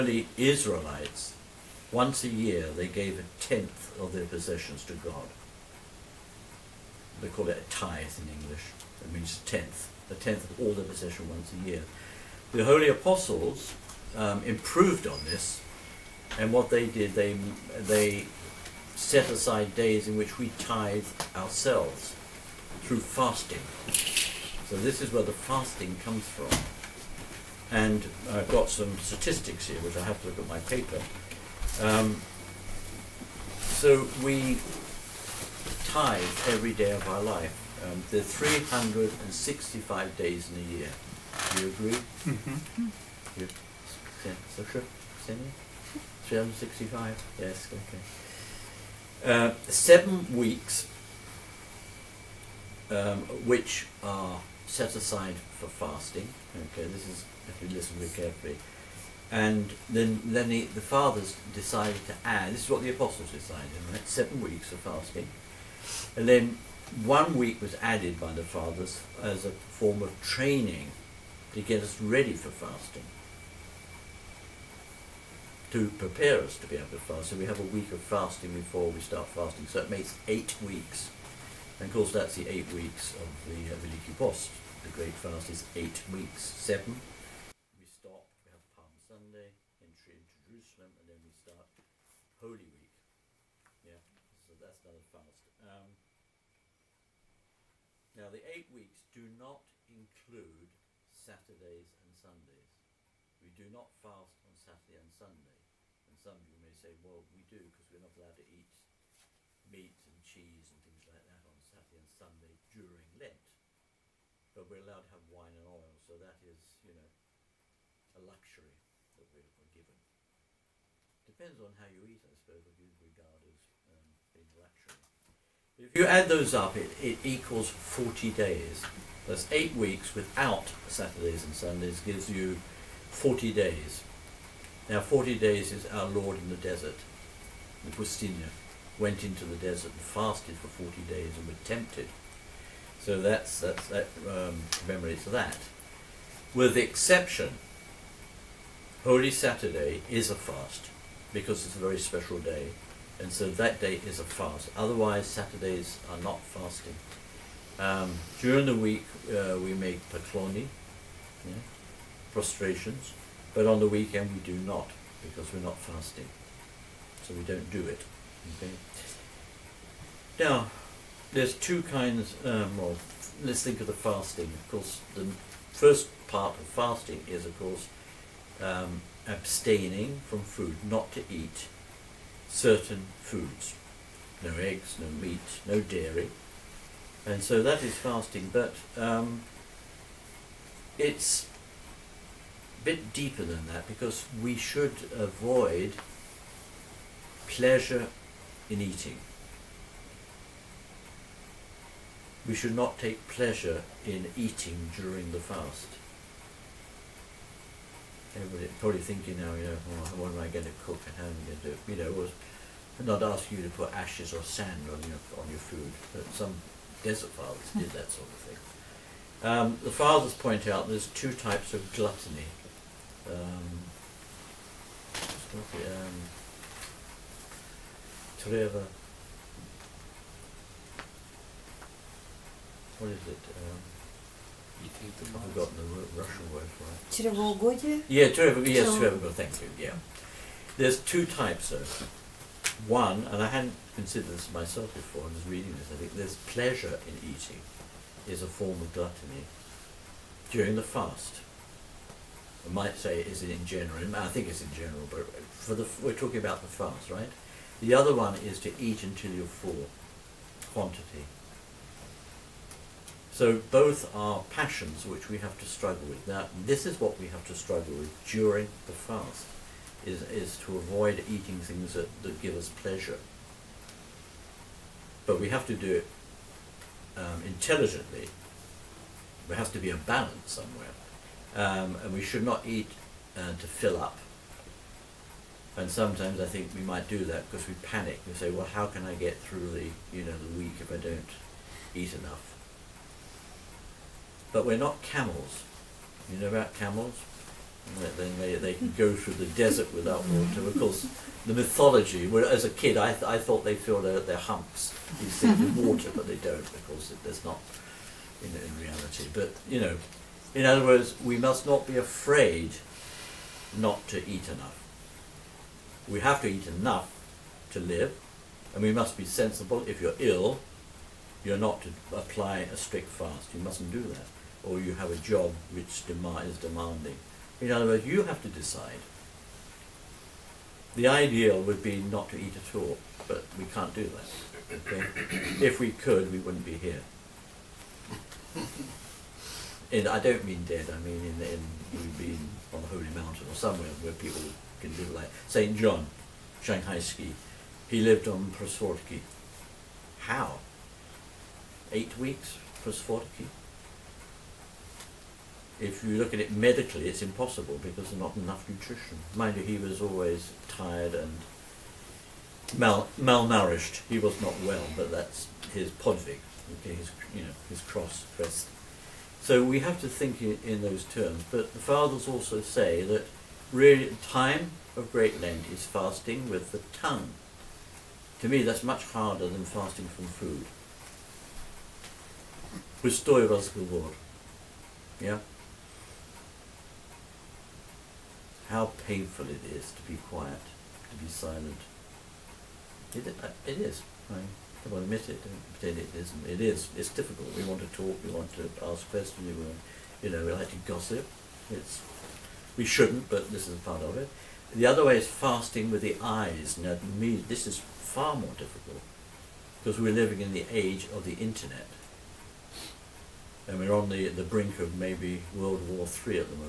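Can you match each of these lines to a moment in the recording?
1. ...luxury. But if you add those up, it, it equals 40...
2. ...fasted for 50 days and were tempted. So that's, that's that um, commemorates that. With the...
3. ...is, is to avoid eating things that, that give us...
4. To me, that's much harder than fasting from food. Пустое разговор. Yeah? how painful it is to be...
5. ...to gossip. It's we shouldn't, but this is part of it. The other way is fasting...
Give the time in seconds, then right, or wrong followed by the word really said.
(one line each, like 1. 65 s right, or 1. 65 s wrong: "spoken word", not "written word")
1. 124 s right
2. 140 s wrong: "40", not "50"
3. 270 s right
4. 378 s right
5. 400 s right.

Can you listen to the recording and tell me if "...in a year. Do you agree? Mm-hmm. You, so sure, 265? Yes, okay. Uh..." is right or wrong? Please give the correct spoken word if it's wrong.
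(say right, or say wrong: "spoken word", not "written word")
wrong: "365", not "265".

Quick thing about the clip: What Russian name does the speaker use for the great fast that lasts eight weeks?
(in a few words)
Veliki Post.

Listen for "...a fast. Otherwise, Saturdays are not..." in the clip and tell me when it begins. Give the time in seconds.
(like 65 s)
154 s.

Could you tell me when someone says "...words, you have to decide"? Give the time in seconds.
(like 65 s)
327 s.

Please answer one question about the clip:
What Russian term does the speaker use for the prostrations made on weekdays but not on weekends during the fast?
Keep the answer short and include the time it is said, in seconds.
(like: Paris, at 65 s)
pakloni, at 160 s.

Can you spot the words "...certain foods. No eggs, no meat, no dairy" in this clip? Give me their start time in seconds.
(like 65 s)
182 s.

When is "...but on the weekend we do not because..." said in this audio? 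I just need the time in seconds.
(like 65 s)
163 s.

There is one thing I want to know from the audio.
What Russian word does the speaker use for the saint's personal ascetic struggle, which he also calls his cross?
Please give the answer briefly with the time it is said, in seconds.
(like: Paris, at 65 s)
podvig, at 365 s.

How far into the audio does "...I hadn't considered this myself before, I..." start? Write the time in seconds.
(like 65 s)
243 s.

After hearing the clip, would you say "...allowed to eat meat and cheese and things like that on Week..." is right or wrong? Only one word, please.
wrong.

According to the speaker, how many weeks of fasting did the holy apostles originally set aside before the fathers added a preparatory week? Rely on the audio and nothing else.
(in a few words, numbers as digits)
7.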